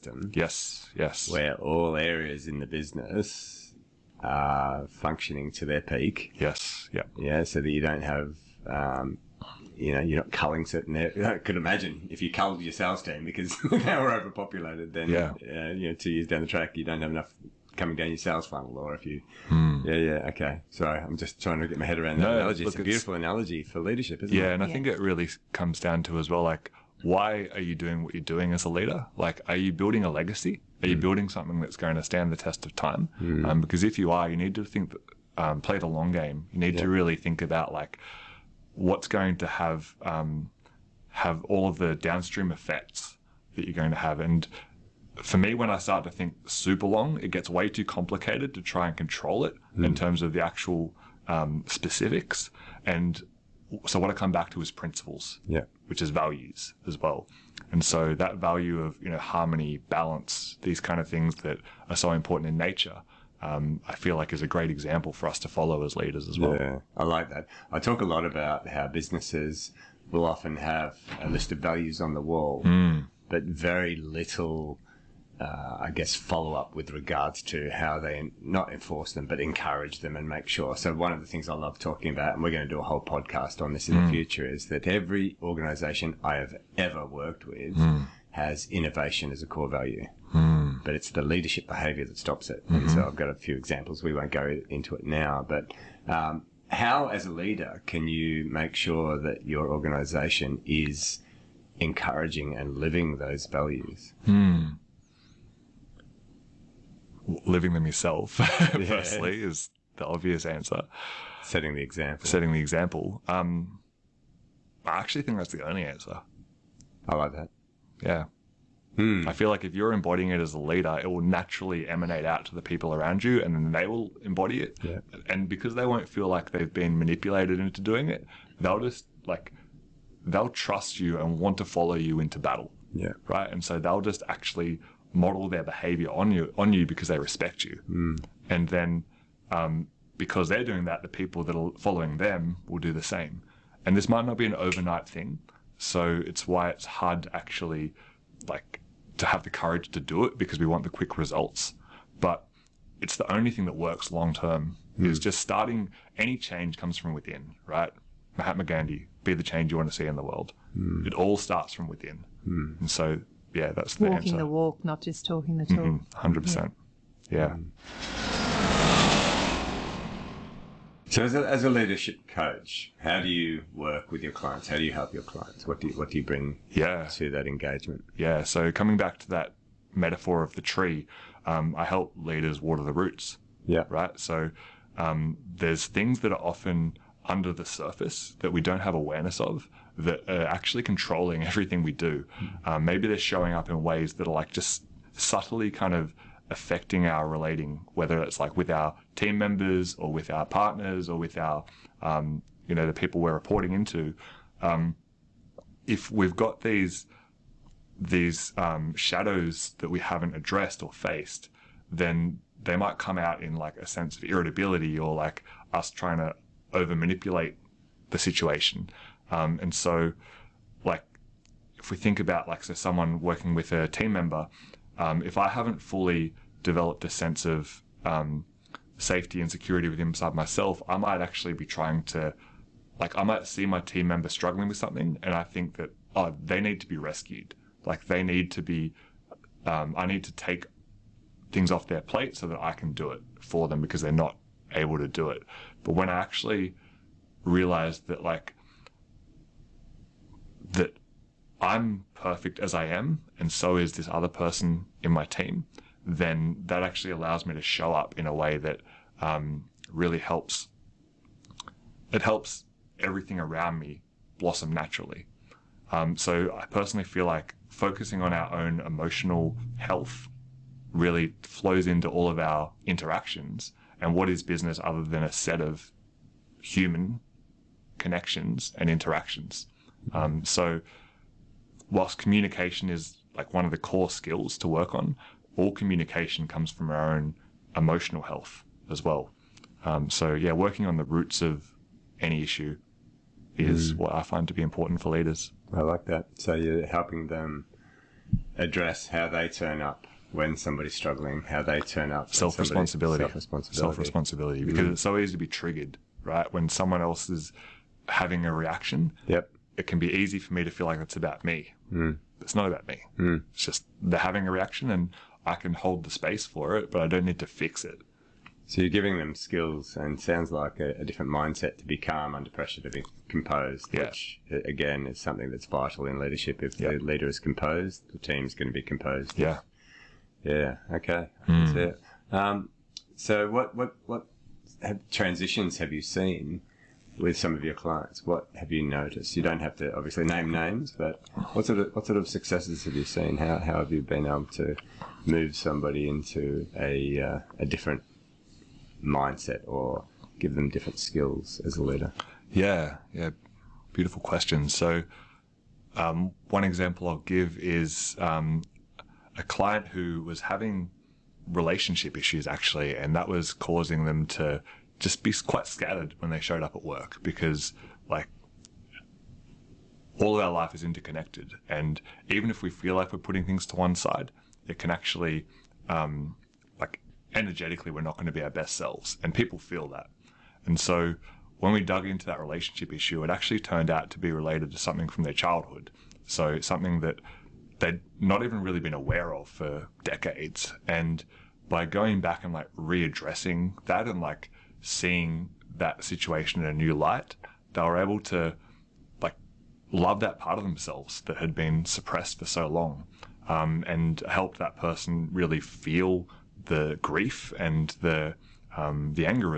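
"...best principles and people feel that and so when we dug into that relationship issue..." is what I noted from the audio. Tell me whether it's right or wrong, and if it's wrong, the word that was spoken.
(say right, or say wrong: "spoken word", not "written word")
wrong: "selves", not "principles".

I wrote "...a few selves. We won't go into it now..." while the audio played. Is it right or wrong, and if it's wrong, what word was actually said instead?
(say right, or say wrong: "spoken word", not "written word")
wrong: "examples", not "selves".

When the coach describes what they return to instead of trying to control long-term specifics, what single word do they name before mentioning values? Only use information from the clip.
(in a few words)
Principles.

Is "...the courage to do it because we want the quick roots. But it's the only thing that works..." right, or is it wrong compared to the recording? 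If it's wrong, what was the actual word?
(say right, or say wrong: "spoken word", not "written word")
wrong: "results", not "roots".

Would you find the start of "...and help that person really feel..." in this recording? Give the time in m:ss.
6:43.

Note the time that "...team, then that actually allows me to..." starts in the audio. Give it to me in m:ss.
4:15.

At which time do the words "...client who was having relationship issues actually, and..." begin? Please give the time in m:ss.
5:59.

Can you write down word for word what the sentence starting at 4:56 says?
So you're helping them address how they turn up when somebody's struggling, how they turn up.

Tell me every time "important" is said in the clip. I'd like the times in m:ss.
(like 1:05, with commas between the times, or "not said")
1:02, 4:54.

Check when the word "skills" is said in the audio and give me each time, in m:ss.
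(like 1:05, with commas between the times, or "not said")
4:44, 5:19, 5:50.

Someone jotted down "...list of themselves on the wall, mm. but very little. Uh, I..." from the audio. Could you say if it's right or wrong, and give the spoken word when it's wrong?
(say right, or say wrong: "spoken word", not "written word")
wrong: "values", not "themselves".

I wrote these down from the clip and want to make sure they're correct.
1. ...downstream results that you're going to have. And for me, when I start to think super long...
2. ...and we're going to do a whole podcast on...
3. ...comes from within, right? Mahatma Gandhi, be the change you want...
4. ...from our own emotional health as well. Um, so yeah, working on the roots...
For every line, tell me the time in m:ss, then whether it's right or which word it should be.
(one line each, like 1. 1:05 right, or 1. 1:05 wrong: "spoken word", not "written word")
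1. 0:41 wrong: "effects", not "results"
2. 1:22 right
3. 2:36 right
4. 4:46 right.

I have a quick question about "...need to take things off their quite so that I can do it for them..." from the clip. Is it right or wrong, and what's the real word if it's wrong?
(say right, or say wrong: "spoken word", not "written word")
wrong: "plate", not "quite".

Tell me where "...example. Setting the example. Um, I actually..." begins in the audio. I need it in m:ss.
1:51.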